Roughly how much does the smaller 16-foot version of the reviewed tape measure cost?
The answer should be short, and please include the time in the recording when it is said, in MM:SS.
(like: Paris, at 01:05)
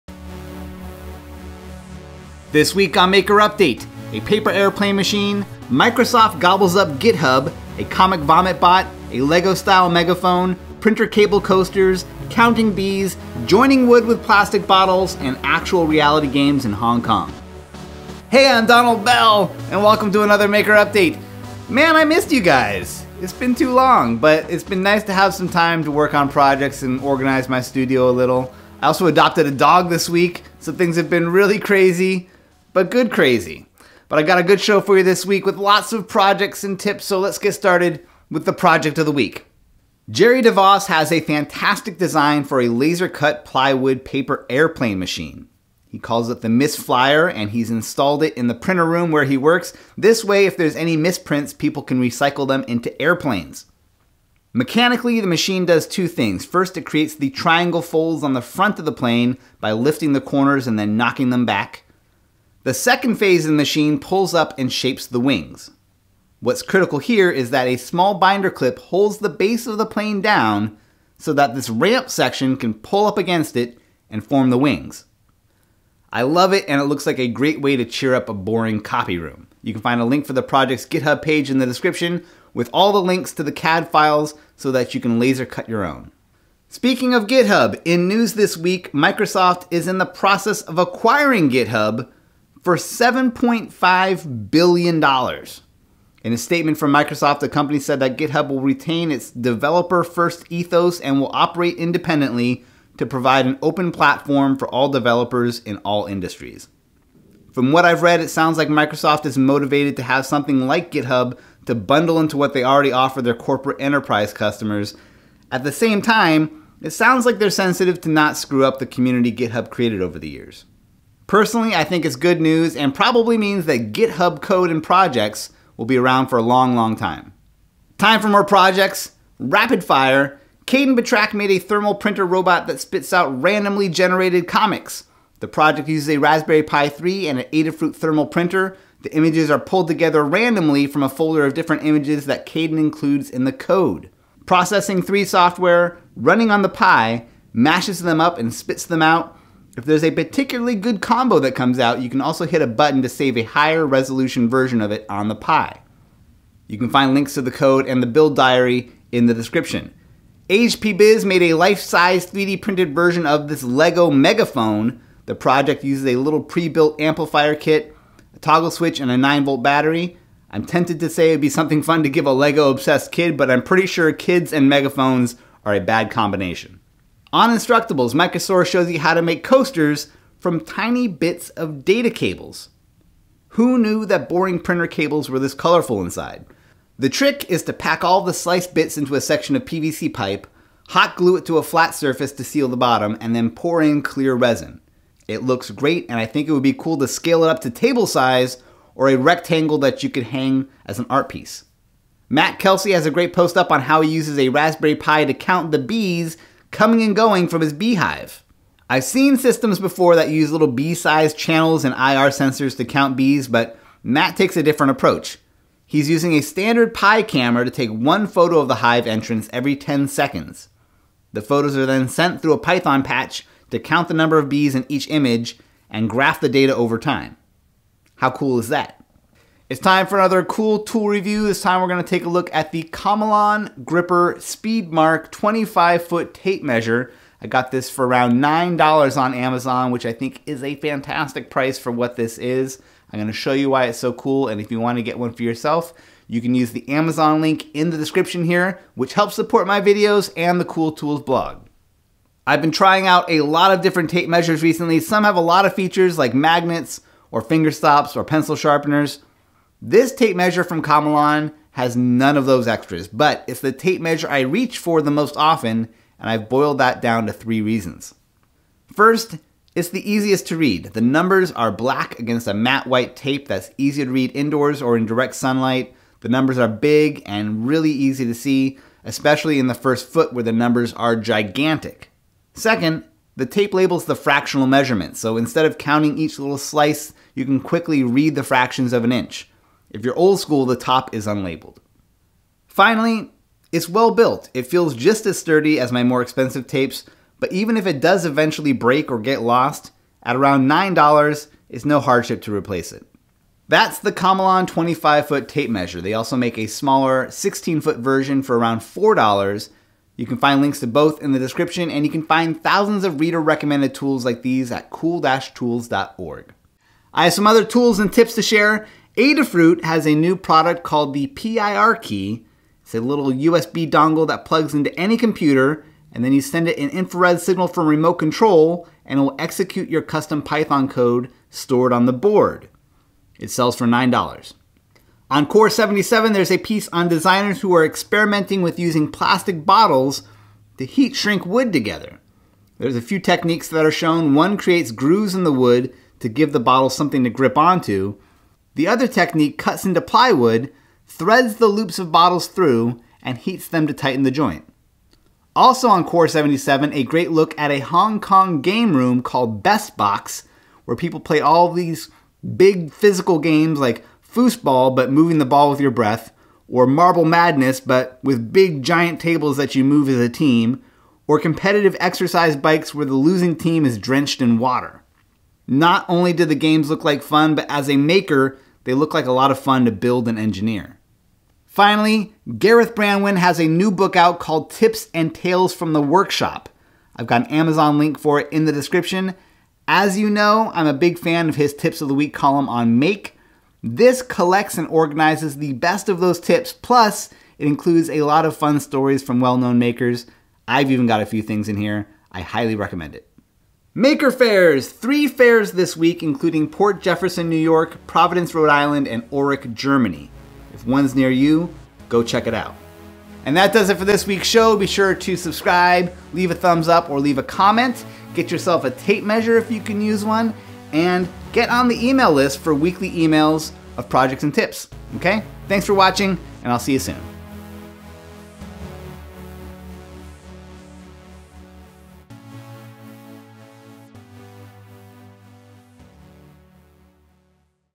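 $4, at 05:08.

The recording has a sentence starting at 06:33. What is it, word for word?
This collects and organizes the best of those tips, plus, it includes a lot of fun stories from well known makers.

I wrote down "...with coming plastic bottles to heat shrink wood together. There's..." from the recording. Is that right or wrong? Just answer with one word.
wrong.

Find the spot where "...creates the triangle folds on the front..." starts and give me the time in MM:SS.
00:56.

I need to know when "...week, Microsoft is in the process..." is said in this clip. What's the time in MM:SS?
01:28.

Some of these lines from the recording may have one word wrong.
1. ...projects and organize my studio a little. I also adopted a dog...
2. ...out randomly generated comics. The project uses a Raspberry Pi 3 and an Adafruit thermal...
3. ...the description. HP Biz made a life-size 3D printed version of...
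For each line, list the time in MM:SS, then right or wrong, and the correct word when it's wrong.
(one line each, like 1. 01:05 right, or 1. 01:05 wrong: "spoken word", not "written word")
1. 00:26 right
2. 02:13 right
3. 02:39 right.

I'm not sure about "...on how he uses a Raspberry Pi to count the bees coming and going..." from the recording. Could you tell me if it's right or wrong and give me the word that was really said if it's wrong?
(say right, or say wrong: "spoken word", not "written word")
right.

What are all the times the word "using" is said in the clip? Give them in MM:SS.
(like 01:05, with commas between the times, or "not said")
03:36, 05:38.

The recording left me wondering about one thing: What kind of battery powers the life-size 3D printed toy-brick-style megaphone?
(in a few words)
9-volt.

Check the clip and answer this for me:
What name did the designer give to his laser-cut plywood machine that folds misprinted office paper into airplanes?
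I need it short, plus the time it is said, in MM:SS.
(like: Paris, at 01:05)
Miss Flyer, at 00:46.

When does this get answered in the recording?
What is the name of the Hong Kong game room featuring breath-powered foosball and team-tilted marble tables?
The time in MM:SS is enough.
05:59.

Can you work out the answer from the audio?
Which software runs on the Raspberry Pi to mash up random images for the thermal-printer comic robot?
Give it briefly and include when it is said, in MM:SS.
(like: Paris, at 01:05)
Processing 3, at 02:24.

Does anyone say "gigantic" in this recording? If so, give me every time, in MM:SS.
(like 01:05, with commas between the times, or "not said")
04:41.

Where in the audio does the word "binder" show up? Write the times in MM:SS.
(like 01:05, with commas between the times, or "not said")
01:08.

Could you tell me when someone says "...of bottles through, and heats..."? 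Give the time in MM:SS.
05:51.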